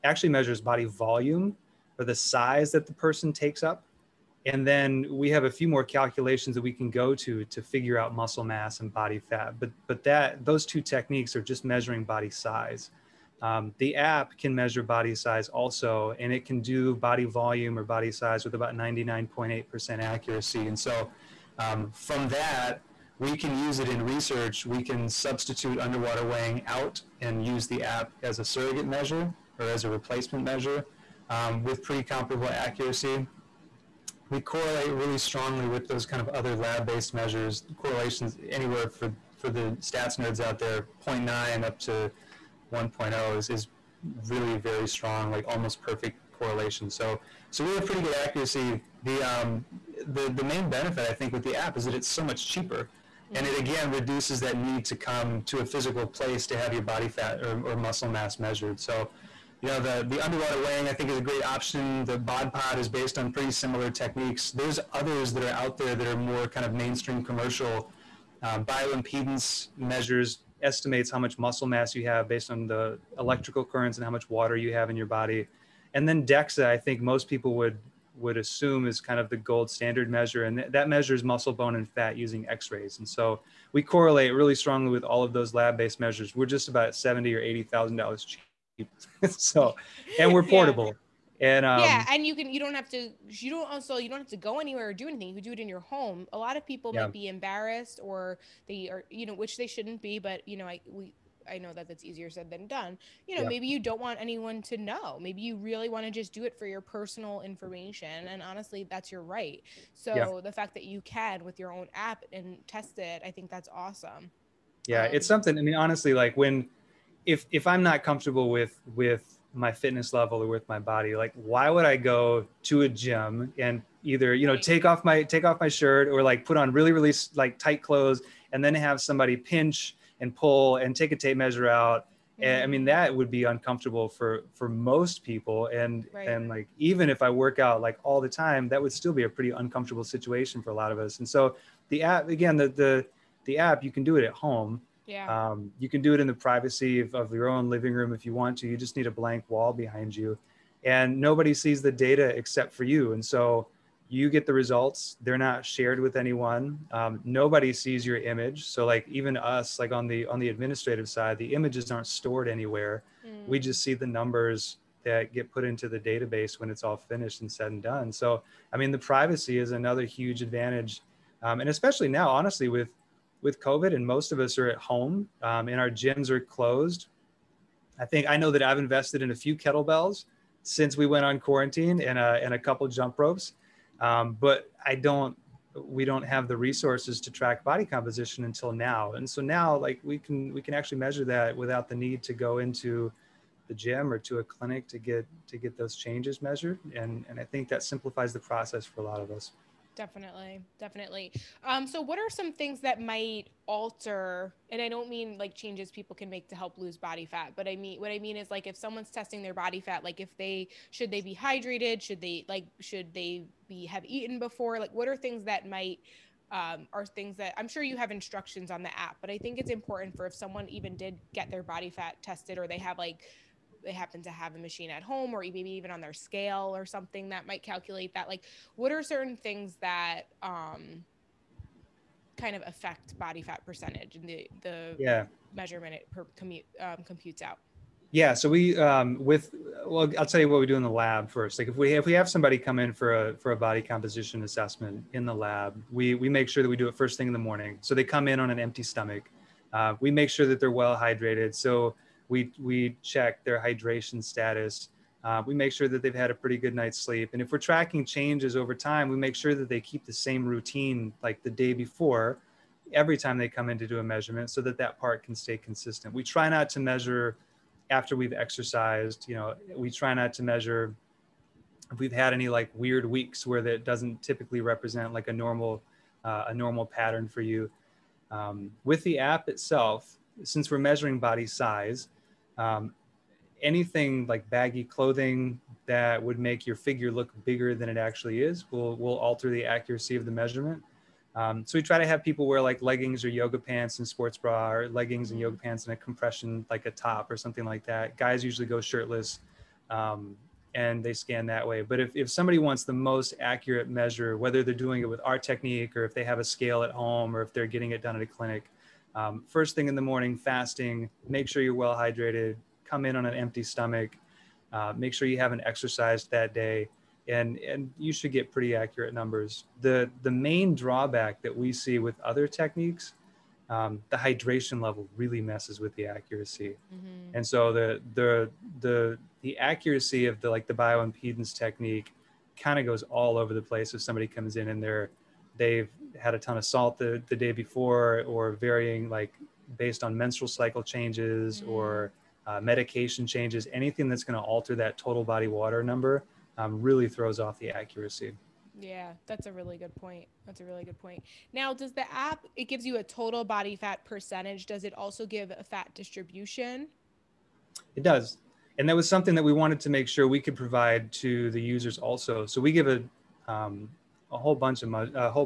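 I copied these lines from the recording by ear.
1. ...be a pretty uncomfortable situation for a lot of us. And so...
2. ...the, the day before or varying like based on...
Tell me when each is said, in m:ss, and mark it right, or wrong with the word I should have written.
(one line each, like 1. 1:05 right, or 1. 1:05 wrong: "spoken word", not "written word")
1. 2:19 right
2. 5:36 right.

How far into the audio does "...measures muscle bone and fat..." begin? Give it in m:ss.
1:20.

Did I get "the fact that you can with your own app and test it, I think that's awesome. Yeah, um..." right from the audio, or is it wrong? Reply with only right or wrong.
right.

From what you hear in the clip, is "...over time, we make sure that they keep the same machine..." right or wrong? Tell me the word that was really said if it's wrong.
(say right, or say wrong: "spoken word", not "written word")
wrong: "routine", not "machine".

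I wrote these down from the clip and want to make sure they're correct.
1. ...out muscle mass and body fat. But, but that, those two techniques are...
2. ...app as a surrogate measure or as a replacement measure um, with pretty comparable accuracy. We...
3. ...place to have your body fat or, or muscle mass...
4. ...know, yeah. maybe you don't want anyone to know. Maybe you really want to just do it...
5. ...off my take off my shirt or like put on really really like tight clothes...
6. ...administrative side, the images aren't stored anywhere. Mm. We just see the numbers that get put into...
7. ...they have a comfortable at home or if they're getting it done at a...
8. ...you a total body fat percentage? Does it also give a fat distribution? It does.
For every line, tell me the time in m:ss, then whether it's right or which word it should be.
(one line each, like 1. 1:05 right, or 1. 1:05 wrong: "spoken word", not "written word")
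1. 0:07 right
2. 0:27 right
3. 0:56 right
4. 1:43 right
5. 2:04 right
6. 2:40 right
7. 5:06 wrong: "scale", not "comfortable"
8. 5:52 right.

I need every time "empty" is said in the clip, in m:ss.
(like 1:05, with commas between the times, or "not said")
4:08, 5:13.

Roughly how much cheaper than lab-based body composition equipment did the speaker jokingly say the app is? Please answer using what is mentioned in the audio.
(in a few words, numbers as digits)
70 or 80 thousand dollars.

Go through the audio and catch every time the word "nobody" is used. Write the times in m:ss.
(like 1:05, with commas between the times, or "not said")
2:31, 2:37.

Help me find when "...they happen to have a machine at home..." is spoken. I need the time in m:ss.
3:43.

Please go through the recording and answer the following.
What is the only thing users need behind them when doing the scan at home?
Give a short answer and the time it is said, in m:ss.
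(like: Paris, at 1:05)
a blank wall, at 2:29.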